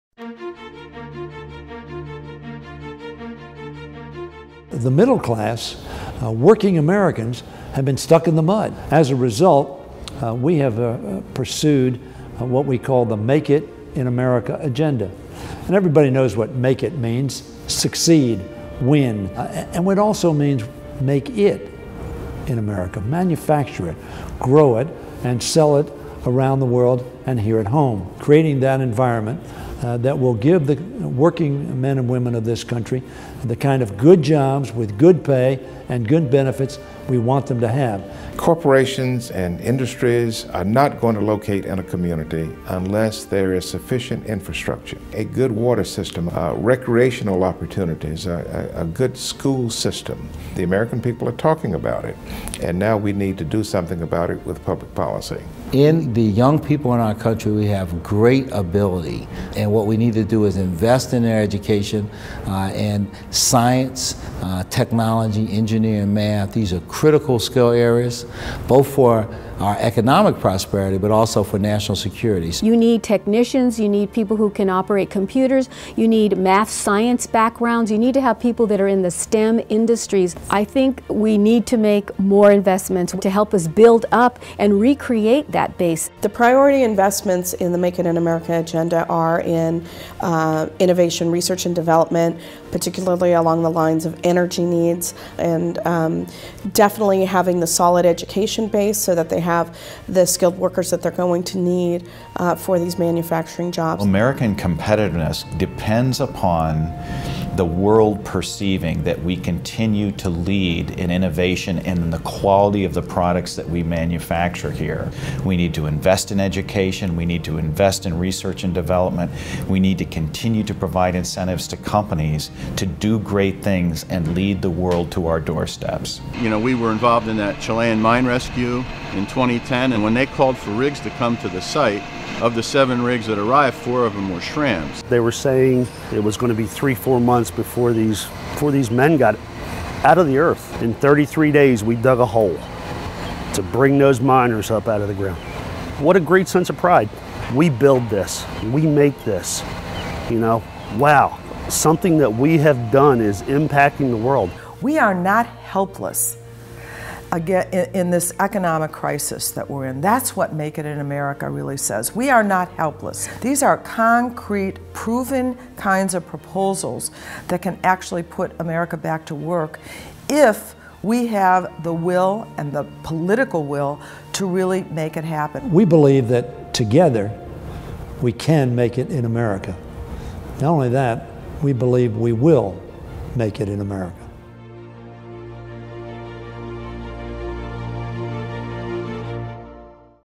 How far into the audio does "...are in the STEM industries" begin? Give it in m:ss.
1:18.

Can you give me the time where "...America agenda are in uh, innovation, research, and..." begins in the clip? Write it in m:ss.
1:28.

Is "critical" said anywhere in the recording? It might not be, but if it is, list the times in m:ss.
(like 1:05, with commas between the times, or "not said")
1:06.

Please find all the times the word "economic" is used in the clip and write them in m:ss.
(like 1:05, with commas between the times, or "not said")
1:09, 2:38.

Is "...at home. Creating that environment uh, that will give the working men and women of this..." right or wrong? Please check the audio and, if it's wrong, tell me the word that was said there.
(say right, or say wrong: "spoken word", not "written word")
right.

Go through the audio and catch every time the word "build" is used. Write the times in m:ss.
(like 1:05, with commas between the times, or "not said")
1:23, 2:27.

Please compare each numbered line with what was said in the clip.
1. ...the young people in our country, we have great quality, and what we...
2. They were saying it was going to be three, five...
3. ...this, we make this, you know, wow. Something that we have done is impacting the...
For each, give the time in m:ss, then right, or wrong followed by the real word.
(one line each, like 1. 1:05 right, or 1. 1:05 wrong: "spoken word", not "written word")
1. 0:56 wrong: "ability", not "quality"
2. 2:15 wrong: "four", not "five"
3. 2:28 right.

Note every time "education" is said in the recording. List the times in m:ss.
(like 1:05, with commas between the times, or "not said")
1:01, 1:38, 1:56.